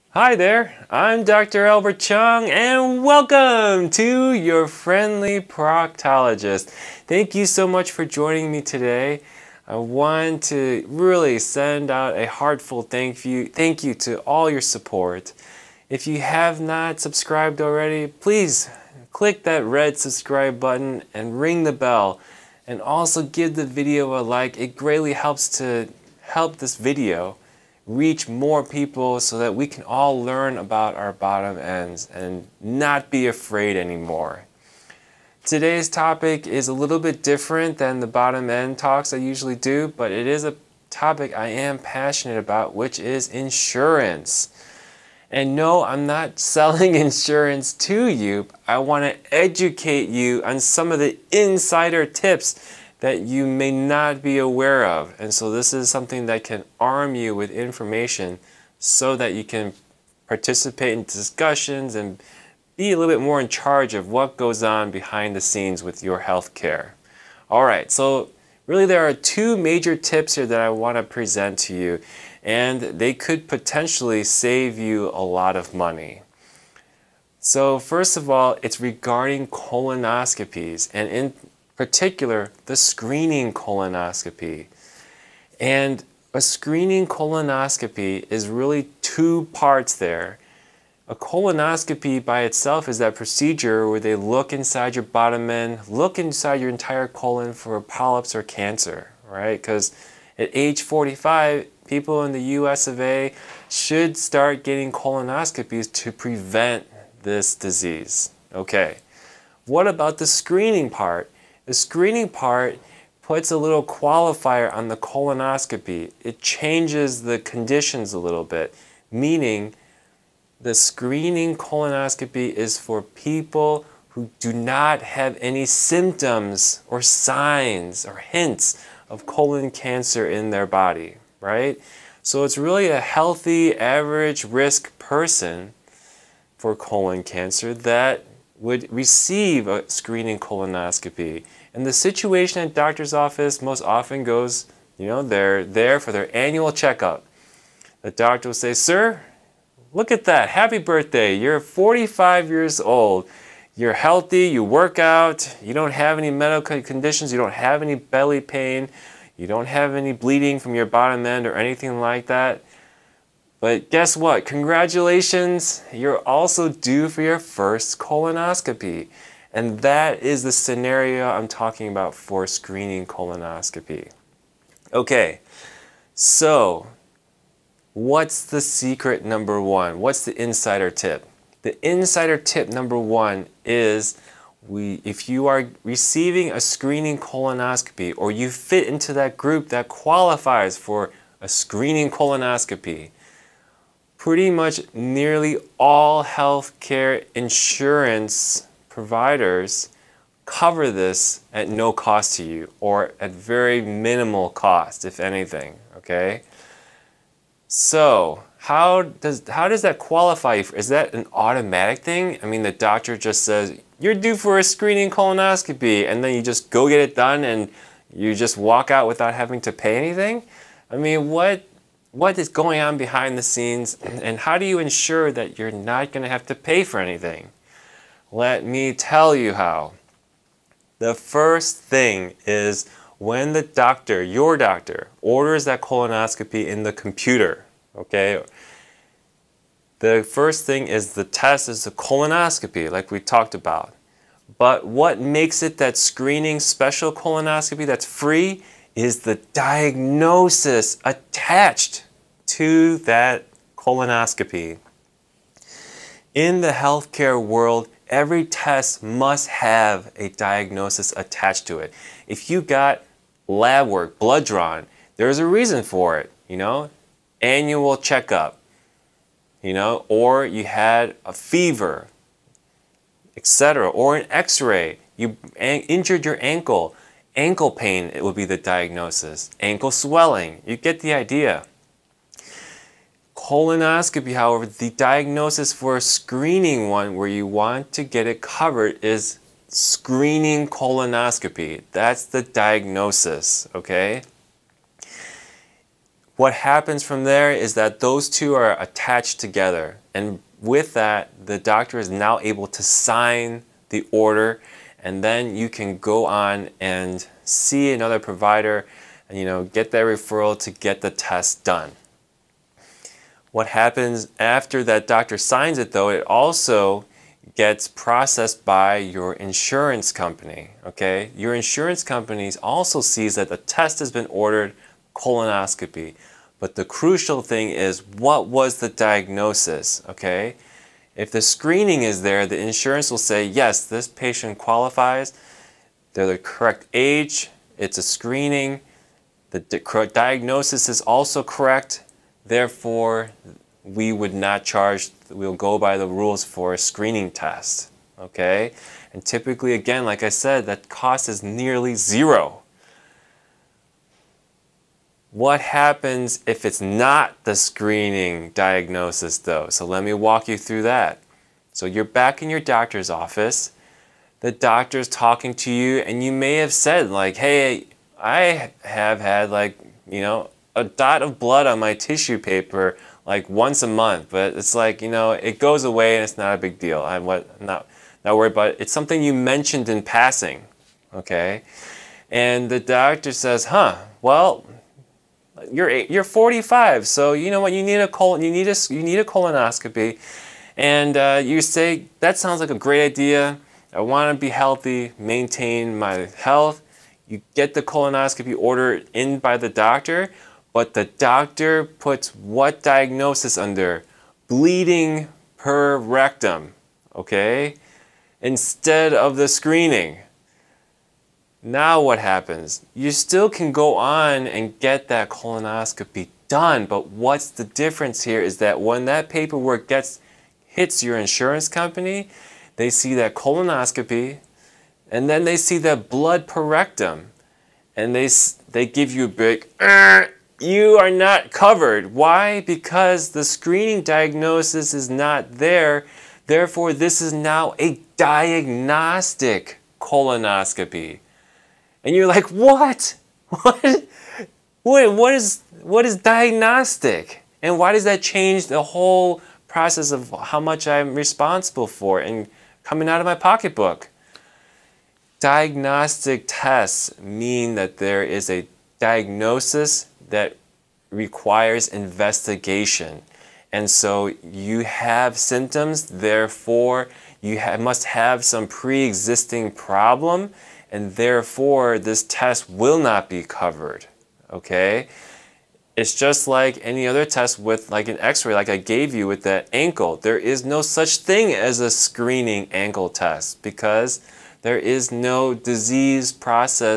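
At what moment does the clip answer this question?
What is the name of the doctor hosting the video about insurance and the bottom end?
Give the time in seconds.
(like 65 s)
1 s.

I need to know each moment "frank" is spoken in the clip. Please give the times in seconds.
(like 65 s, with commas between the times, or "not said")
not said.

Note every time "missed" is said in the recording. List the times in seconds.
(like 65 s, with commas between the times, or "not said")
not said.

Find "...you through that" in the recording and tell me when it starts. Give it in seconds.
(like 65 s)
360 s.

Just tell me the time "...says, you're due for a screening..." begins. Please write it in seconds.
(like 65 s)
213 s.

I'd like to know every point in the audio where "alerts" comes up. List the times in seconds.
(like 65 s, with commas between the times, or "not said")
not said.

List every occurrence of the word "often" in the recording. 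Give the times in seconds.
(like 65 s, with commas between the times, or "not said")
143 s.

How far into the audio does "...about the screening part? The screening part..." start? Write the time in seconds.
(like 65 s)
109 s.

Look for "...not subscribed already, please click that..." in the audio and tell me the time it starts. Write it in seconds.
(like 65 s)
16 s.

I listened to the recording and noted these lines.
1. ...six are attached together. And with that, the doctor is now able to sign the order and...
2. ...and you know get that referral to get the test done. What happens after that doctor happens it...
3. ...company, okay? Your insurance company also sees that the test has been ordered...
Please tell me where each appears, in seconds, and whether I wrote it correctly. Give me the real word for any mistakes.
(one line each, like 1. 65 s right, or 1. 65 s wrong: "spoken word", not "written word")
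1. 298 s wrong: "two", not "six"
2. 309 s wrong: "signs", not "happens"
3. 320 s right.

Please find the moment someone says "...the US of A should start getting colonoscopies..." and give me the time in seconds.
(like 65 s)
102 s.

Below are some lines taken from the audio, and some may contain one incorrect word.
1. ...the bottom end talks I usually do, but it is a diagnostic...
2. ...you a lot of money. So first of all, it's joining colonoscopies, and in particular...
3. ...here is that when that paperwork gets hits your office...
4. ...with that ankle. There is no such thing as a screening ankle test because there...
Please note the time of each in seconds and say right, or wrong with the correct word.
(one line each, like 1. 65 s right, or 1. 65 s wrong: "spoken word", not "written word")
1. 38 s wrong: "topic", not "diagnostic"
2. 74 s wrong: "regarding", not "joining"
3. 418 s wrong: "insurance", not "office"
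4. 479 s right.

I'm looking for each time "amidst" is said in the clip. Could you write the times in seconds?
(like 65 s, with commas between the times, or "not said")
not said.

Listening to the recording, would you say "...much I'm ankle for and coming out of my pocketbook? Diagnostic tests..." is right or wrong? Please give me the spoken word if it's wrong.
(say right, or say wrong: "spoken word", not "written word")
wrong: "responsible", not "ankle".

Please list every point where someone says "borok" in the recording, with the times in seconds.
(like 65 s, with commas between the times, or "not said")
not said.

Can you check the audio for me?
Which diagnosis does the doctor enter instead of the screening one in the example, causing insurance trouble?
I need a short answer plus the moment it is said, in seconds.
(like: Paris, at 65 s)
Bleeding per rectum, at 404 s.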